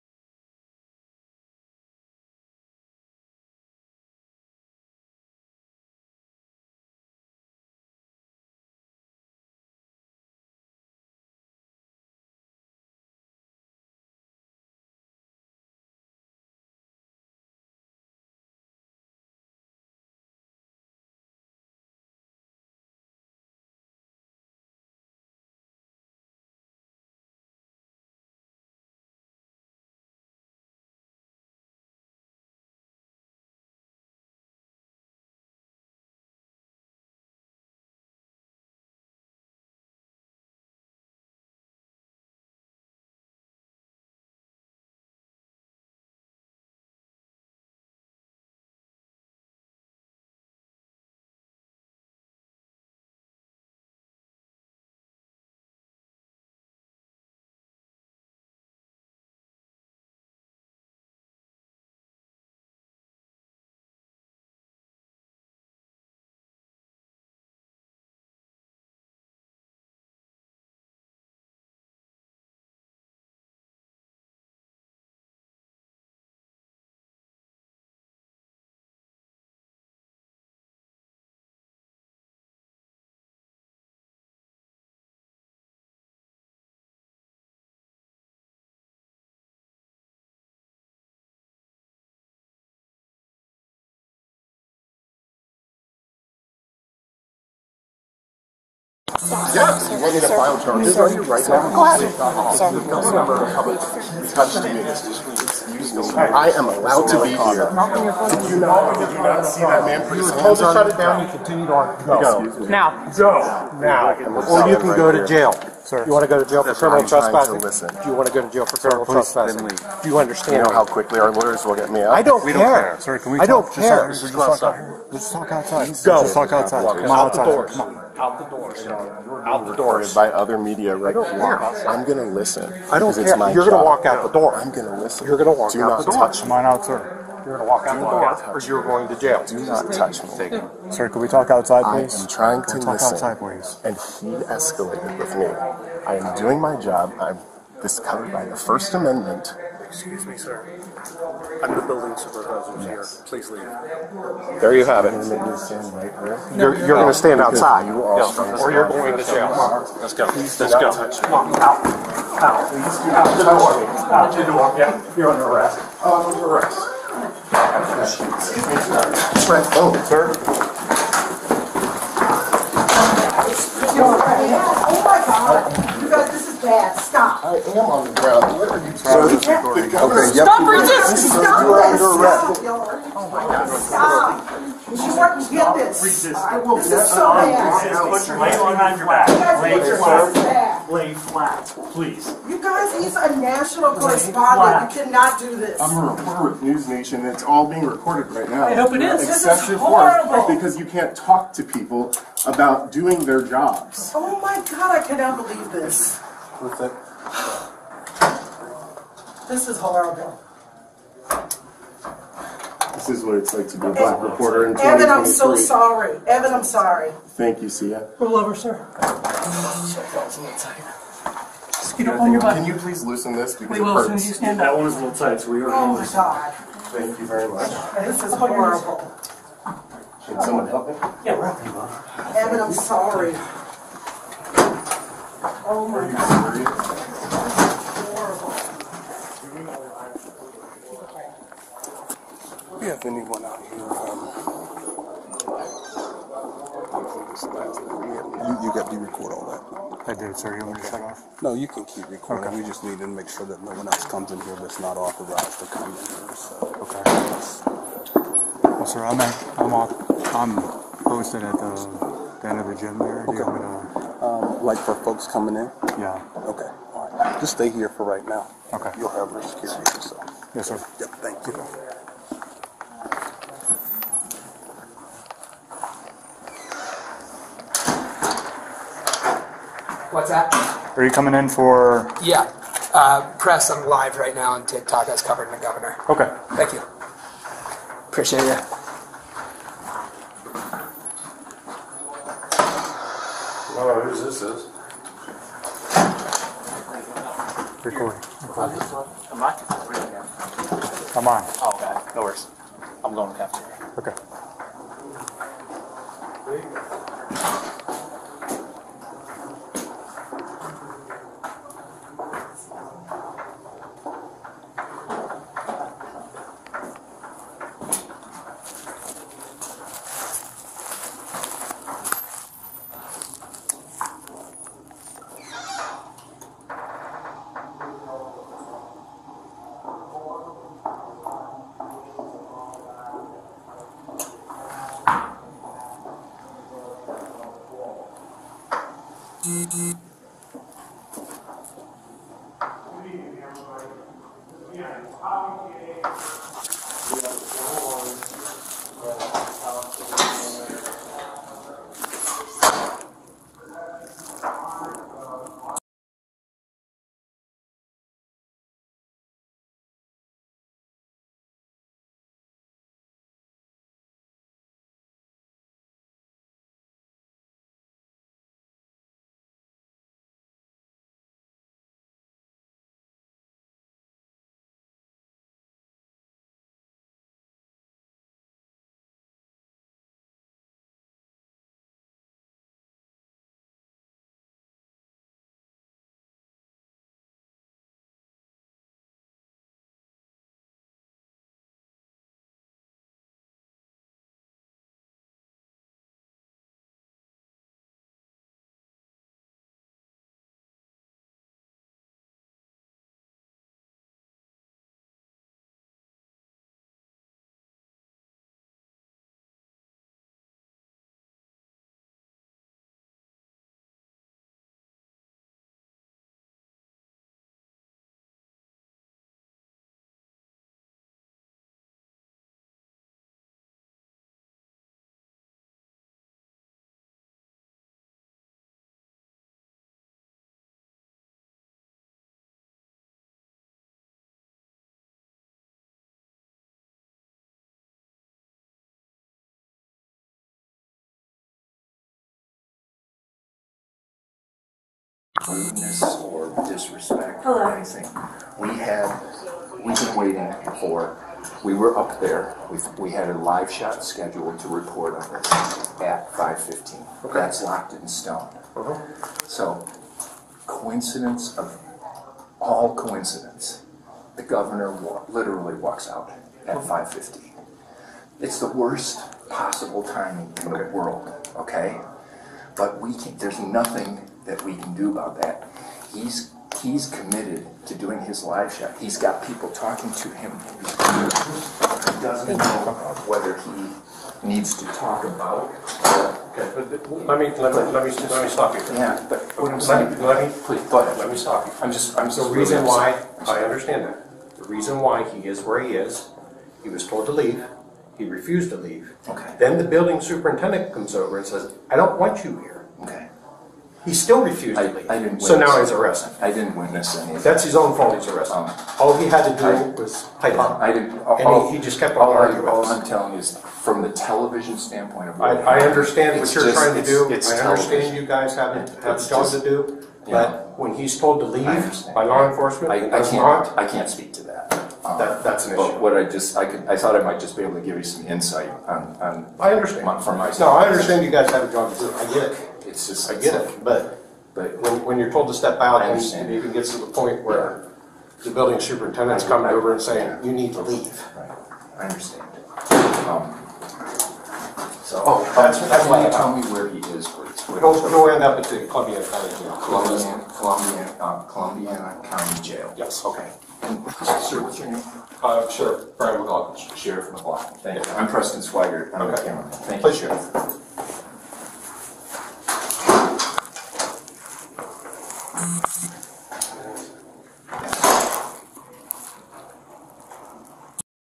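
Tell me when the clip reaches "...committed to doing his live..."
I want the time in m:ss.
7:57.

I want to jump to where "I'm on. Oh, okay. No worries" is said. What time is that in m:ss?
5:01.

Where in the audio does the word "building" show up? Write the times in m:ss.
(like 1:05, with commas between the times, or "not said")
2:31, 8:19, 8:58.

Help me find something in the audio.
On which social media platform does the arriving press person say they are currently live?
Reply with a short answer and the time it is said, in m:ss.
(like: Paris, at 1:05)
TikTok, at 4:44.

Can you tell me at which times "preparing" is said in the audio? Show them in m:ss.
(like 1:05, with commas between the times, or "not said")
not said.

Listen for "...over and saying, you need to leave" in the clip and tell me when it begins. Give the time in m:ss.
8:59.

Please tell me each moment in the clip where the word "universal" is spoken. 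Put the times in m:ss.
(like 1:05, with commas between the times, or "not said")
not said.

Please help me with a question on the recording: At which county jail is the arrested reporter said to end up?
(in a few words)
Columbiana County Jail.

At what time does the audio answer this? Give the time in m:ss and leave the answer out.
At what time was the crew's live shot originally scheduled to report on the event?
7:36.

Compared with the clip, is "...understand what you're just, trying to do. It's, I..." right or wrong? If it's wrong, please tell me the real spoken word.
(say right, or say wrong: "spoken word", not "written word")
right.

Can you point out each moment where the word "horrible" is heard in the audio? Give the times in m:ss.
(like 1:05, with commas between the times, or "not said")
3:29, 3:48.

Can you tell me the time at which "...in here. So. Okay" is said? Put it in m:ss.
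4:15.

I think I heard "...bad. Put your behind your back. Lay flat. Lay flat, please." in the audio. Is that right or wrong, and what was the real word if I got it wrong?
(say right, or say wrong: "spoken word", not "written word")
right.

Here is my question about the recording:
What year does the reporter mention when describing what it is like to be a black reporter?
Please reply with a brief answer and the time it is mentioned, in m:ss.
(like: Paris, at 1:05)
2023, at 3:34.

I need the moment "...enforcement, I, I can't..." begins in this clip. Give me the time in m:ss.
8:42.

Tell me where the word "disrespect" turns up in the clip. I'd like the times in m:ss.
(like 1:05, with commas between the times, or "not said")
7:26.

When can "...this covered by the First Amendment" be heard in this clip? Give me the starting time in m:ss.
2:27.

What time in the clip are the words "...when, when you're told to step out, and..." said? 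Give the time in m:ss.
8:54.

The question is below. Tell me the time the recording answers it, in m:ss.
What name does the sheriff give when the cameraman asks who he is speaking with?
9:16.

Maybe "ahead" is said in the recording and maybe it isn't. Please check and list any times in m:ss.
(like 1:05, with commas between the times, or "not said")
1:41, 8:10.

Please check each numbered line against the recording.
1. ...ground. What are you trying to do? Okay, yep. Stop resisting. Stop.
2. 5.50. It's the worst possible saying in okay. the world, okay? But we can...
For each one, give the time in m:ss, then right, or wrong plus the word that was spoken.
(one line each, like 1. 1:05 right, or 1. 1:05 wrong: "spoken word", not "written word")
1. 2:58 right
2. 7:47 wrong: "timing", not "saying".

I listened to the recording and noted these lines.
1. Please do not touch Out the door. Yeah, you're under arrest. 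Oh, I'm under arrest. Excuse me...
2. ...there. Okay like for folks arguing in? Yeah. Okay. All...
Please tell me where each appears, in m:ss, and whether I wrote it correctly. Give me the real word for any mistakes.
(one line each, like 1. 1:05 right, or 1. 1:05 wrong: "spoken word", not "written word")
1. 2:42 right
2. 4:22 wrong: "coming", not "arguing".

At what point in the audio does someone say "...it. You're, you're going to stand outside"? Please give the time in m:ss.
2:35.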